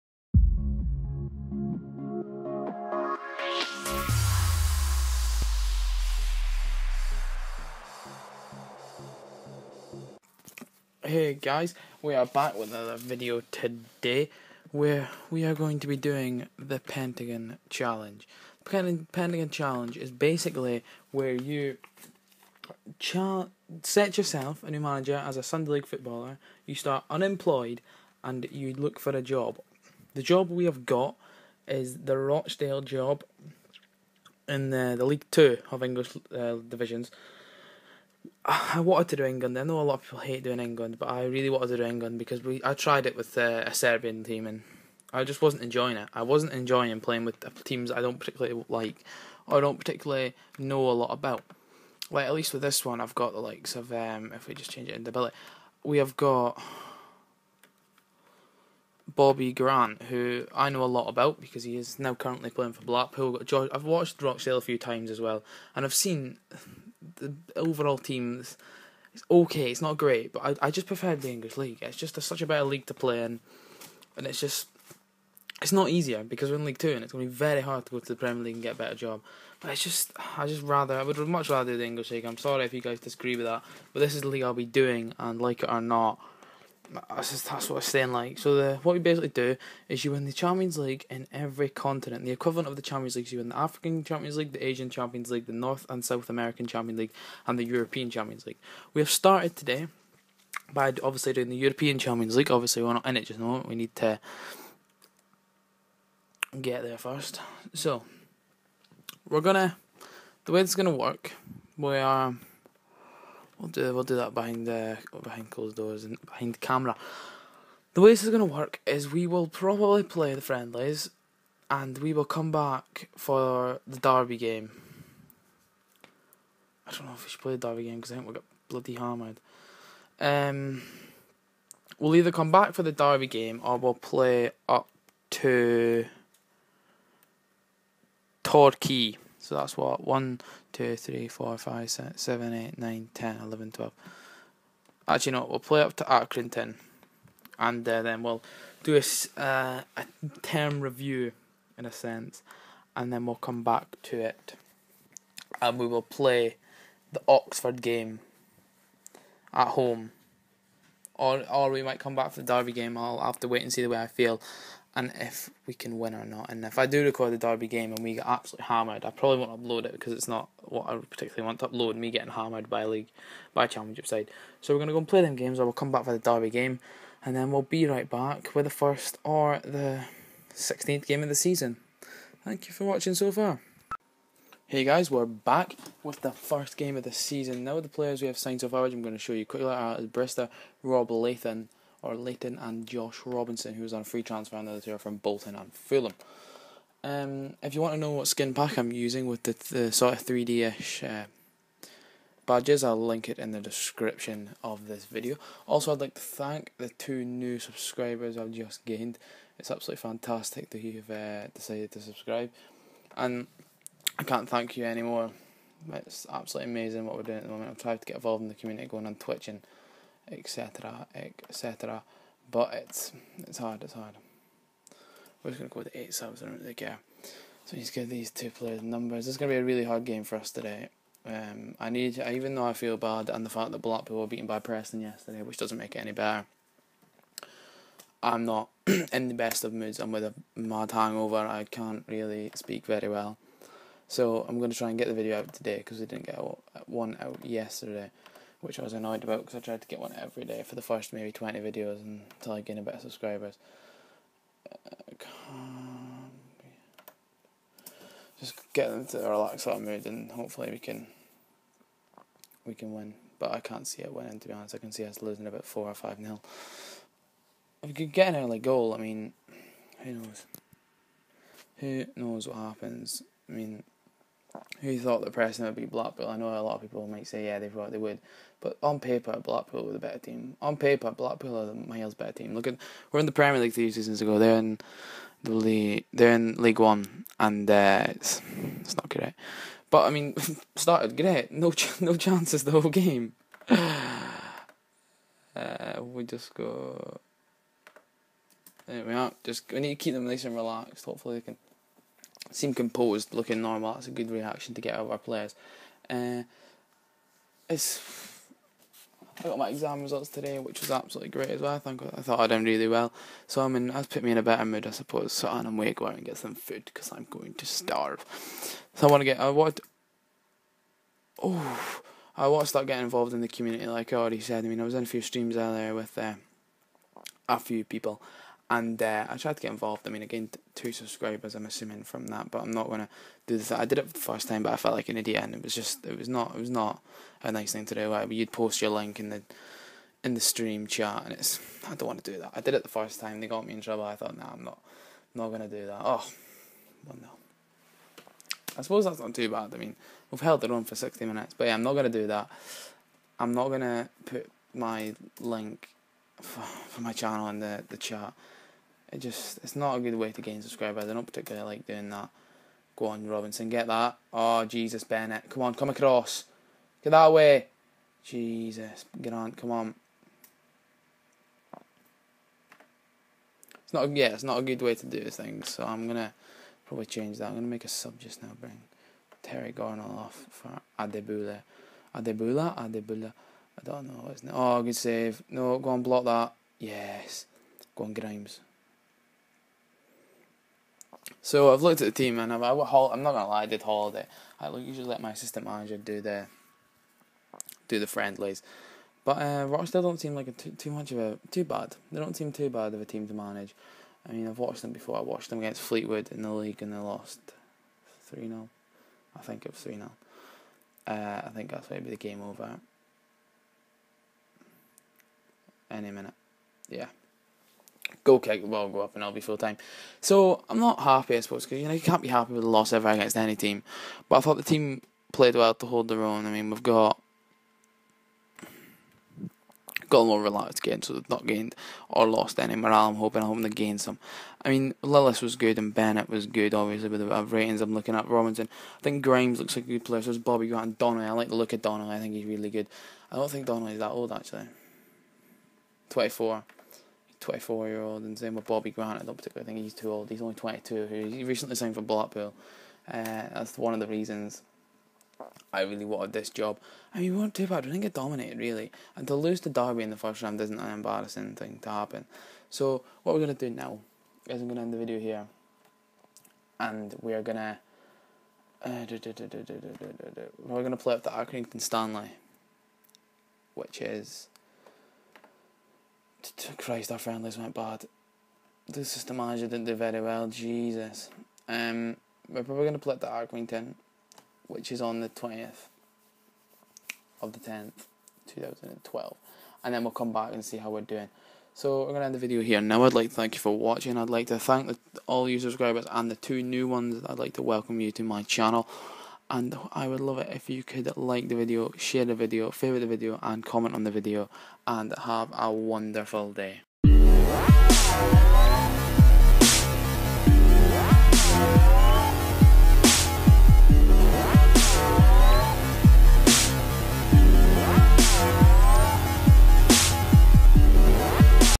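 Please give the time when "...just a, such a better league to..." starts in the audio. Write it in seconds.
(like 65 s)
71 s.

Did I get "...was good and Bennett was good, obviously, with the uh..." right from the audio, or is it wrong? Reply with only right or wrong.
right.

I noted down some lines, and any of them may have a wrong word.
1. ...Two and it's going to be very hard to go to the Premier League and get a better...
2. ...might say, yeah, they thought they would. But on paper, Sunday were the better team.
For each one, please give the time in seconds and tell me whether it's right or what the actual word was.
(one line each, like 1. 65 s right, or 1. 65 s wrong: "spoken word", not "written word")
1. 76 s right
2. 277 s wrong: "Blackpool", not "Sunday".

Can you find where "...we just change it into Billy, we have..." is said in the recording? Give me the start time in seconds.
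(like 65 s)
54 s.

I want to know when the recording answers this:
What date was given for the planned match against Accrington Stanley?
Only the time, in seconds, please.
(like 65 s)
485 s.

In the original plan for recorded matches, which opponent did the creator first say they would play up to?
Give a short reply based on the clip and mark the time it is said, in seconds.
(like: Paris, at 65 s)
Torquay, at 138 s.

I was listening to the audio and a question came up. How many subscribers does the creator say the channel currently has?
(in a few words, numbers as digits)
8.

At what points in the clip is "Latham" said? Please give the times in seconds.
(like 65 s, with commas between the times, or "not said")
191 s.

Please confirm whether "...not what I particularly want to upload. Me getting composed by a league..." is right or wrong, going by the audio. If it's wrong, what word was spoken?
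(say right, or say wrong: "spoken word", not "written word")
wrong: "hammered", not "composed".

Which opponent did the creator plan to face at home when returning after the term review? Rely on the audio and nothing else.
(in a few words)
Oxford.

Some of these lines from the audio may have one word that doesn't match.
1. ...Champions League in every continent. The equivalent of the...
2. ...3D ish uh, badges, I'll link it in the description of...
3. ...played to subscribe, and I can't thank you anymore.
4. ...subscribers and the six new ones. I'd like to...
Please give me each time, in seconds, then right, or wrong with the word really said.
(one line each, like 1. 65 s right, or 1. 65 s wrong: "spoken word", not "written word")
1. 90 s right
2. 200 s right
3. 211 s wrong: "decided", not "played"
4. 495 s wrong: "two", not "six".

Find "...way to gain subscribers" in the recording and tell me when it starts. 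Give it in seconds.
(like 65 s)
360 s.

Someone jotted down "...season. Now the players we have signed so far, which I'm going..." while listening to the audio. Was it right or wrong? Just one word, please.
right.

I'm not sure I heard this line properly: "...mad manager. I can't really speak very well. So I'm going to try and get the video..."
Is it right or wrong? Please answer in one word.
wrong.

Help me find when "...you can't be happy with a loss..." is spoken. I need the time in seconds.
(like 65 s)
421 s.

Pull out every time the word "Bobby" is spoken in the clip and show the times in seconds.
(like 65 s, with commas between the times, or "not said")
59 s, 440 s, 448 s.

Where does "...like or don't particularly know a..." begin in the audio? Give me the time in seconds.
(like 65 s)
48 s.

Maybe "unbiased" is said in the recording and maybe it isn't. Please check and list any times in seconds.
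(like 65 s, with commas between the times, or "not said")
not said.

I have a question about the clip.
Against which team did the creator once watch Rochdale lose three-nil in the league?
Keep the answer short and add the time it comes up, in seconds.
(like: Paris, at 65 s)
Fleetwood, at 405 s.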